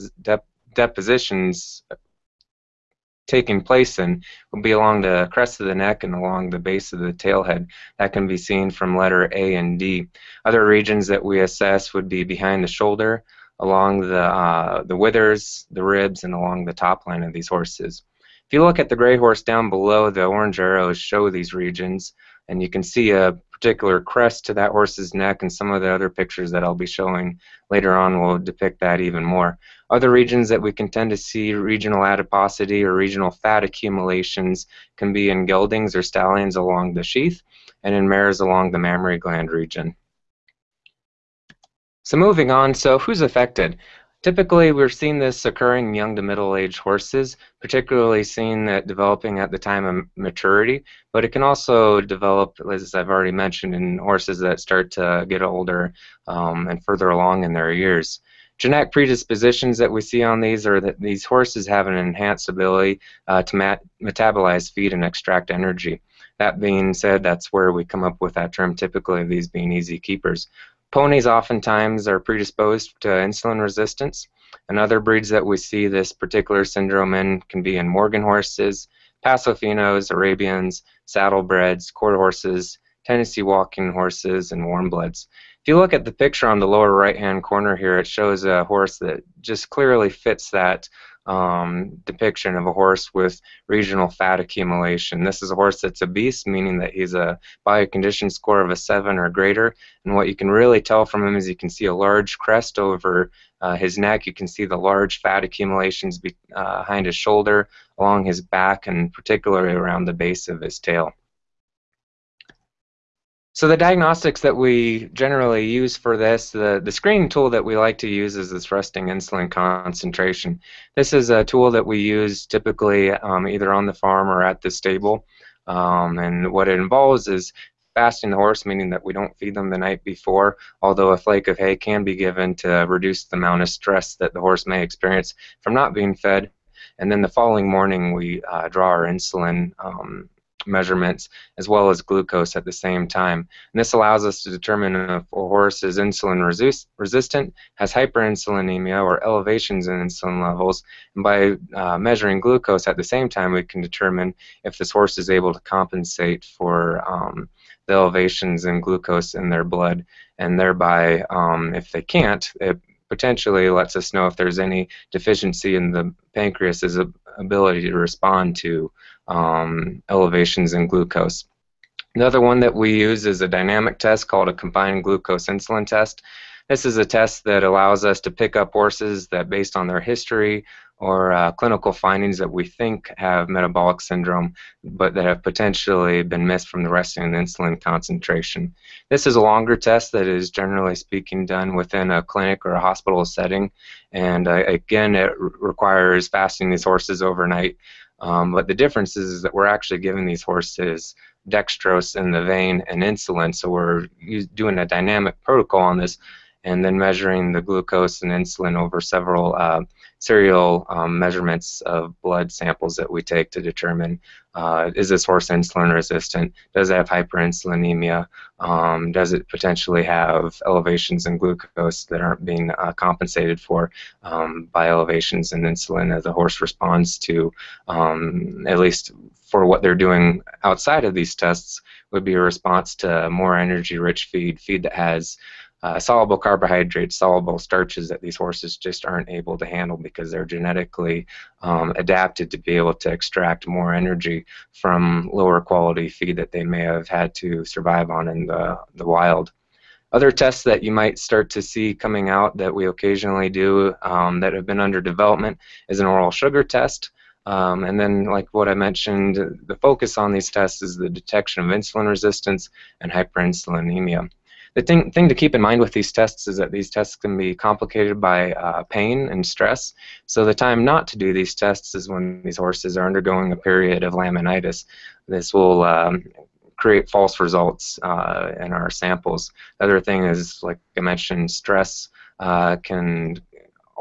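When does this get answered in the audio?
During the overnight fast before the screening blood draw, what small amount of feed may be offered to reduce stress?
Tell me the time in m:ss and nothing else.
2:11.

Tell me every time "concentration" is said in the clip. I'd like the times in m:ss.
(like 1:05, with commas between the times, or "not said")
1:59, 3:07.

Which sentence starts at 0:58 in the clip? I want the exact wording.
Genetic predispositions that we see on these are that these horses have an enhanced ability uh, to metabolize feed and extract energy.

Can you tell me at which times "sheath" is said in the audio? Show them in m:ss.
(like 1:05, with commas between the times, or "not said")
0:37.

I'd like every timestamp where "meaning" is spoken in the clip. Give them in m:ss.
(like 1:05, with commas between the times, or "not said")
1:36, 2:08.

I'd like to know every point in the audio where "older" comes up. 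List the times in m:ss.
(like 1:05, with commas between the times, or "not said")
0:55.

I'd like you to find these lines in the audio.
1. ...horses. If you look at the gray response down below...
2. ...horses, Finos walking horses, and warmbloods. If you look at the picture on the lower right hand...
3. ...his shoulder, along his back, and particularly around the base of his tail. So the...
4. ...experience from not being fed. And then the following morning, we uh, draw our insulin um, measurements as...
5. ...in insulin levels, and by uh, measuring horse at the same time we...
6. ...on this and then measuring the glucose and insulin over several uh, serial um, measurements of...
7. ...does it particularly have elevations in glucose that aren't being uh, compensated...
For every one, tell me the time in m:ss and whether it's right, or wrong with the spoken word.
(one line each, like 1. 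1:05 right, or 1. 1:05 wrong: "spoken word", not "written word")
1. 0:17 wrong: "horse", not "response"
2. 1:22 wrong: "Tennessee", not "Finos"
3. 1:47 right
4. 2:14 right
5. 2:29 wrong: "glucose", not "horse"
6. 3:25 right
7. 3:39 wrong: "potentially", not "particularly".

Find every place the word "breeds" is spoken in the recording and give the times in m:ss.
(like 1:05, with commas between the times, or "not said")
1:14.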